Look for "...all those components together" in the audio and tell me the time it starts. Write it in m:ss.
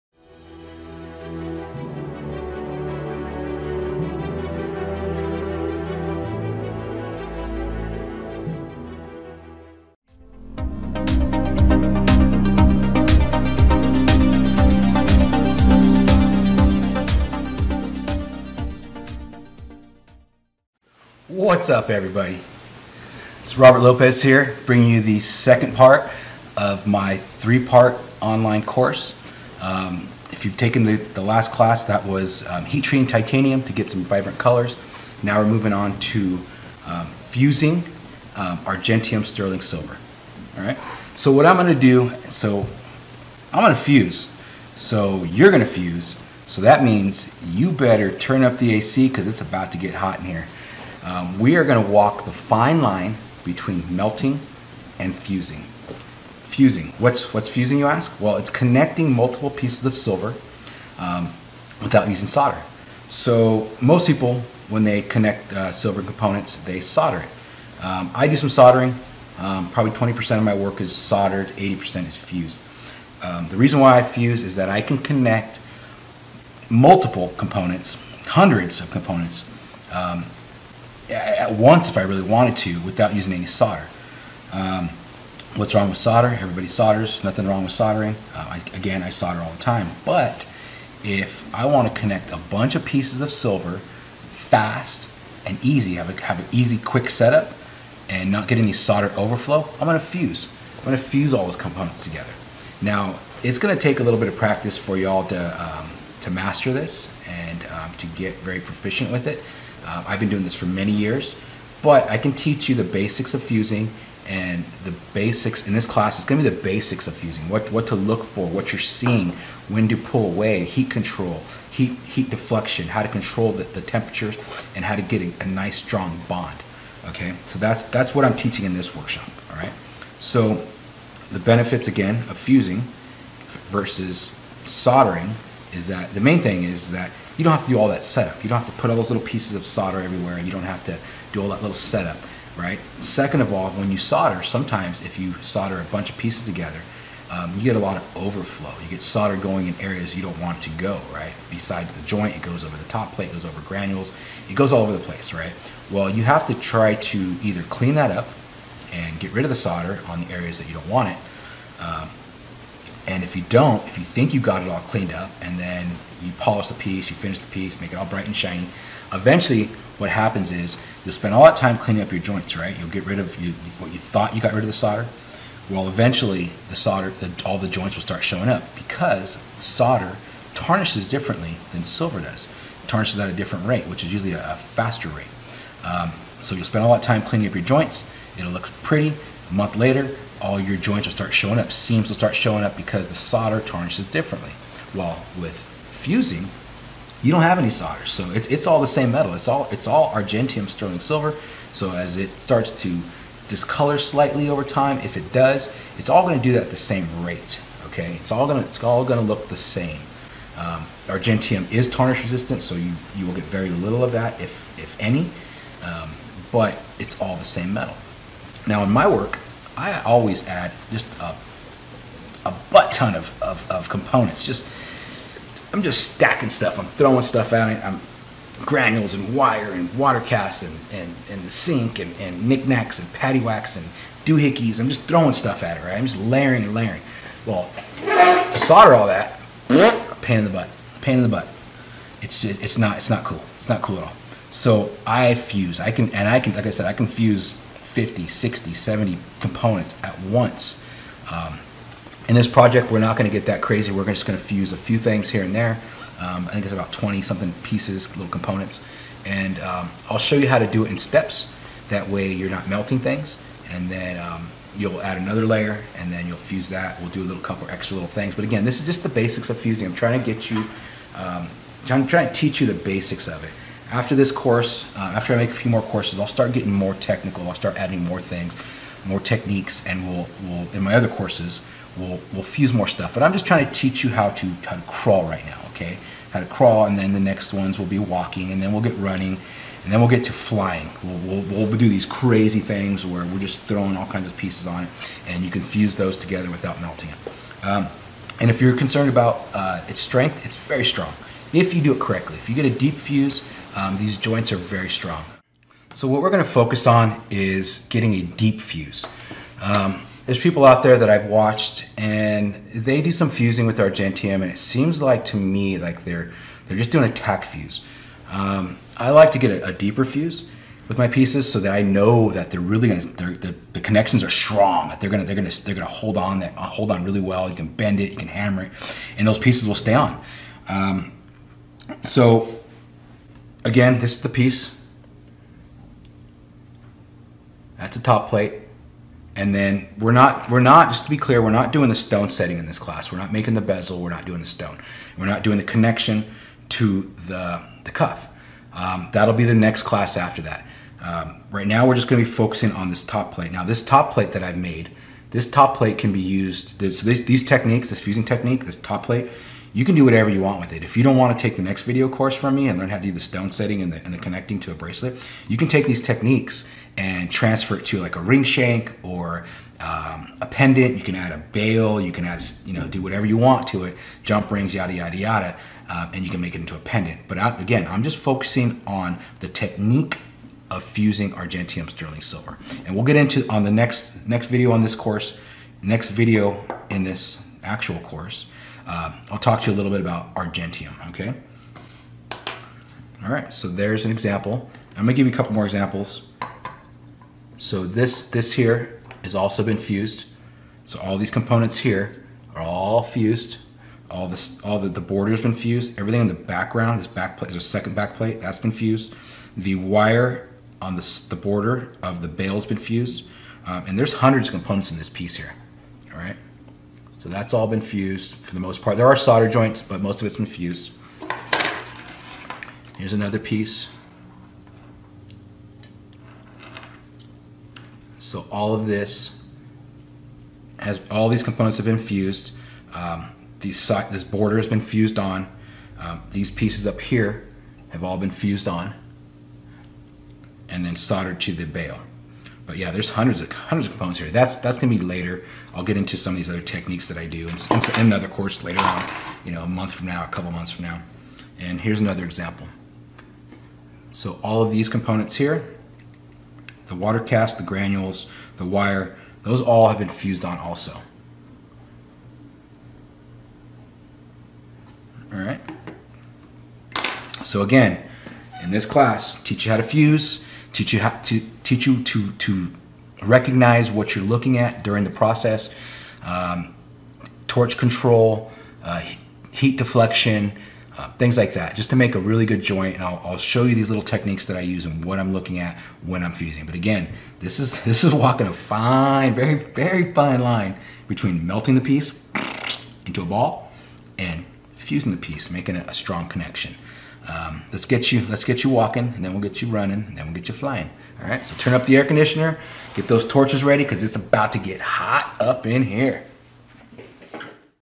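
1:41.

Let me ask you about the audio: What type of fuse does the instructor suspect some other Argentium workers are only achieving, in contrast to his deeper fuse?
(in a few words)
tack fuse.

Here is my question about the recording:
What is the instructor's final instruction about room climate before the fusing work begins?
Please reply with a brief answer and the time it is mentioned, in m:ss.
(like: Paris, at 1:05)
turn up the air conditioner, at 8:21.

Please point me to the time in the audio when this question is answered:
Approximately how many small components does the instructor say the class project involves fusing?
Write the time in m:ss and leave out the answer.
4:16.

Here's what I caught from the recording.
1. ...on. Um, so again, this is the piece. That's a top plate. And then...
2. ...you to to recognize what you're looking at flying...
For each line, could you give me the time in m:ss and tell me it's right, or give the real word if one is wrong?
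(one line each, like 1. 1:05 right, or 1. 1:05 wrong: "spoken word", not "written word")
1. 5:29 right
2. 7:51 wrong: "during", not "flying".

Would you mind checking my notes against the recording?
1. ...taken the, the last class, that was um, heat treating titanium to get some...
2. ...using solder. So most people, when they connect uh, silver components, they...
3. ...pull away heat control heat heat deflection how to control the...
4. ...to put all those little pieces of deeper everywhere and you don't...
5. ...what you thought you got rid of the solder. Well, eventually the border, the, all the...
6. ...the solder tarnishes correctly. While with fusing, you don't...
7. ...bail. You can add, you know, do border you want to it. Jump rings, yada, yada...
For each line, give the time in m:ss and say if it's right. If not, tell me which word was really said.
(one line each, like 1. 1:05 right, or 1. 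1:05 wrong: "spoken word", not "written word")
1. 0:30 right
2. 1:02 right
3. 1:59 right
4. 2:18 wrong: "solder", not "deeper"
5. 2:53 wrong: "solder", not "border"
6. 3:13 wrong: "differently", not "correctly"
7. 6:11 wrong: "whatever", not "border".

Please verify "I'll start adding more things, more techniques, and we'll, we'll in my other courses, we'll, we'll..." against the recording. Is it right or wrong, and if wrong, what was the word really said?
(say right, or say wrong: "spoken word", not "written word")
right.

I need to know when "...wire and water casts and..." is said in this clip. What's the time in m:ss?
3:49.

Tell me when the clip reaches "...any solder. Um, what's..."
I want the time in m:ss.
1:23.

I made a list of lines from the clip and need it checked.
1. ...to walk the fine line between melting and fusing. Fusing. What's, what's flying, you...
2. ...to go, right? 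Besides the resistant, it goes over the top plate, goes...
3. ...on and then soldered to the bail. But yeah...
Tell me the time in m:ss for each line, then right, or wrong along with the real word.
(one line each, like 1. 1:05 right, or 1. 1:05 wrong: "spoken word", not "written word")
1. 0:51 wrong: "fusing", not "flying"
2. 2:30 wrong: "joint", not "resistant"
3. 7:18 right.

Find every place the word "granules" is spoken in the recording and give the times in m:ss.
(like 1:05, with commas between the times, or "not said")
2:33, 3:48, 7:37.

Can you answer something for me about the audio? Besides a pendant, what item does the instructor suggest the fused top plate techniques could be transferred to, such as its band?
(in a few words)
ring shank.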